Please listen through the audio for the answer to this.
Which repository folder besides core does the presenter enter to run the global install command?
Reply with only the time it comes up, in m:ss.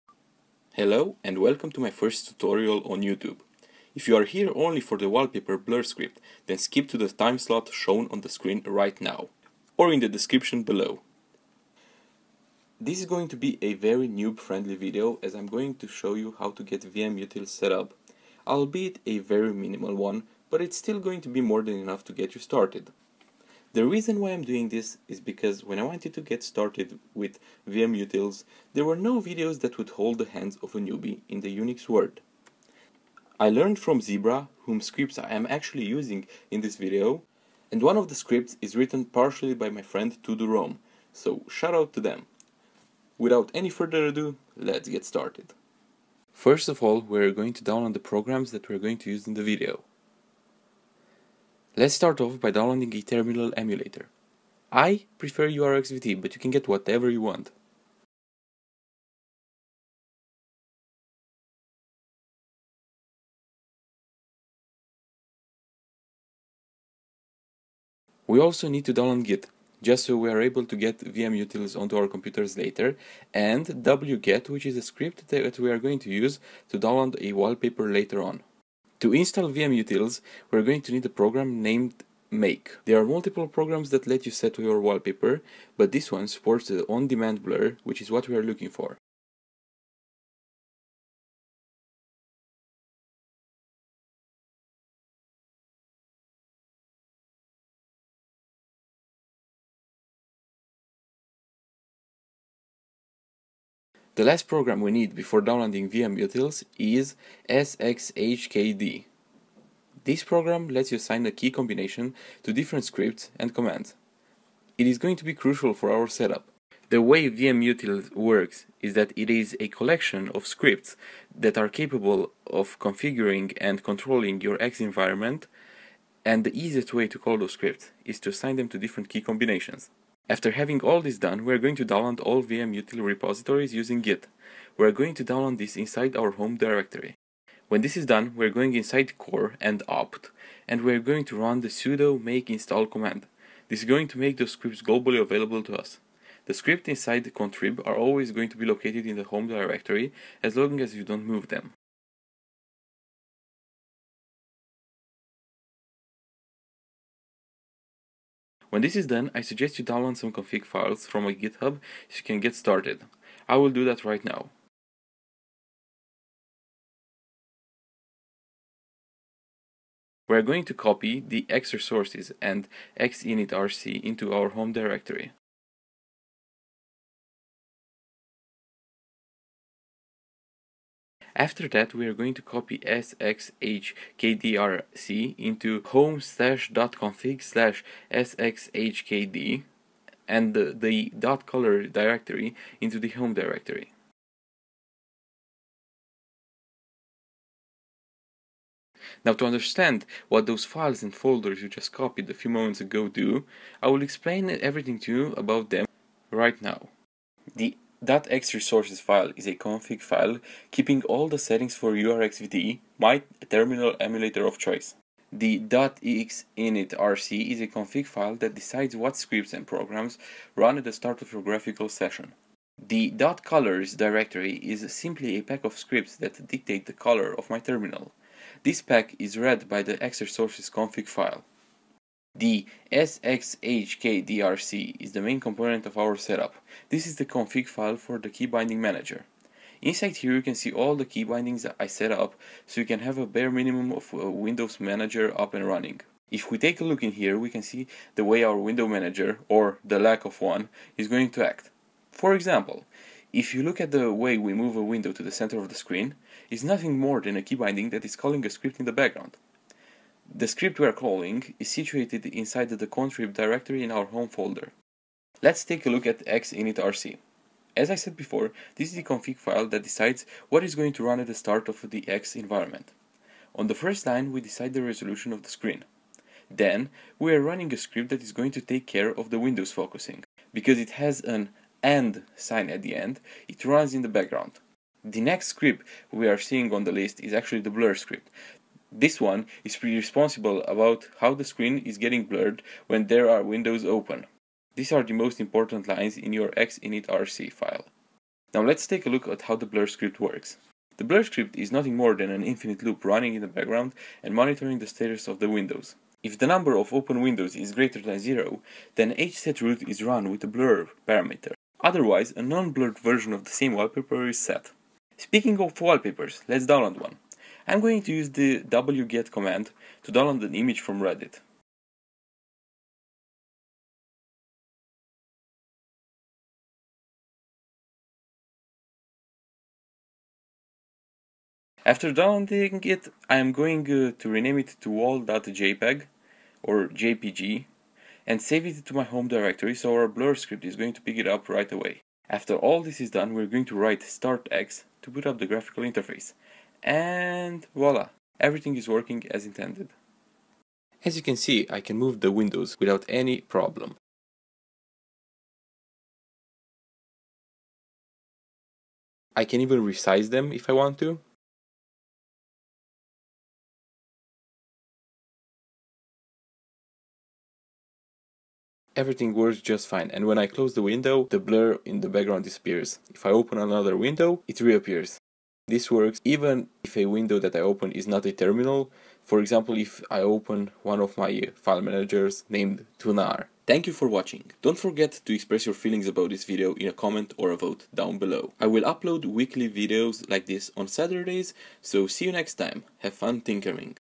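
2:19.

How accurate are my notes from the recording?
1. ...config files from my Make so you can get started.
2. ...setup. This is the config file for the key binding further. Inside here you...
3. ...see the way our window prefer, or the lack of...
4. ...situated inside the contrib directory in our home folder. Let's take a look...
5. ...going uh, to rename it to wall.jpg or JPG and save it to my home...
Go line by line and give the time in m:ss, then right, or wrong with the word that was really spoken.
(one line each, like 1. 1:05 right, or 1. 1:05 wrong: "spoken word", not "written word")
1. 2:40 wrong: "GitHub", not "Make"
2. 3:56 wrong: "manager", not "further"
3. 4:07 wrong: "manager", not "prefer"
4. 4:21 right
5. 5:33 right.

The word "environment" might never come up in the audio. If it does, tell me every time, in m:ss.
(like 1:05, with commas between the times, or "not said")
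2:04, 4:32.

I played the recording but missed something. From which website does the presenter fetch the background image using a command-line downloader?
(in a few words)
Reddit.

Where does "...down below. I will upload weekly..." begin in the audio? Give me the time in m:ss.
6:27.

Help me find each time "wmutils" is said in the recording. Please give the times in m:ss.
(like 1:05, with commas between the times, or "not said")
0:16, 0:27, 1:10, 1:19, 1:45, 1:57, 2:12.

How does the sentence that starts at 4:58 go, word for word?
Now let's take a look at how the blur script works.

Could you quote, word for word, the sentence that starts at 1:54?
It is going to be crucial for our setup.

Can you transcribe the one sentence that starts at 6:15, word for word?
This works even if a window that I open is not a terminal.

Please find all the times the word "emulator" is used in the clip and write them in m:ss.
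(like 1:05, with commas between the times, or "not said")
0:53, 3:33.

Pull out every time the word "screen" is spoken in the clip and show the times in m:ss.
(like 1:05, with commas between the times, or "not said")
0:08, 4:15, 4:35, 4:51.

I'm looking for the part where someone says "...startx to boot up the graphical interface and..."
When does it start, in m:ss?
5:44.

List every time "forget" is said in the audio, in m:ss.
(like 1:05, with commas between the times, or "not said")
6:24.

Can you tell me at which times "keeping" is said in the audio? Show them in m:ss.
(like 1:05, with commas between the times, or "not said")
3:30.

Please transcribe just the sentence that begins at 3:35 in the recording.
The .xinitrc is a config file that decides what scripts and programs run at the start of your graphical session.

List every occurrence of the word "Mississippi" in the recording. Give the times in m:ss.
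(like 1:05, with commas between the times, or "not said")
not said.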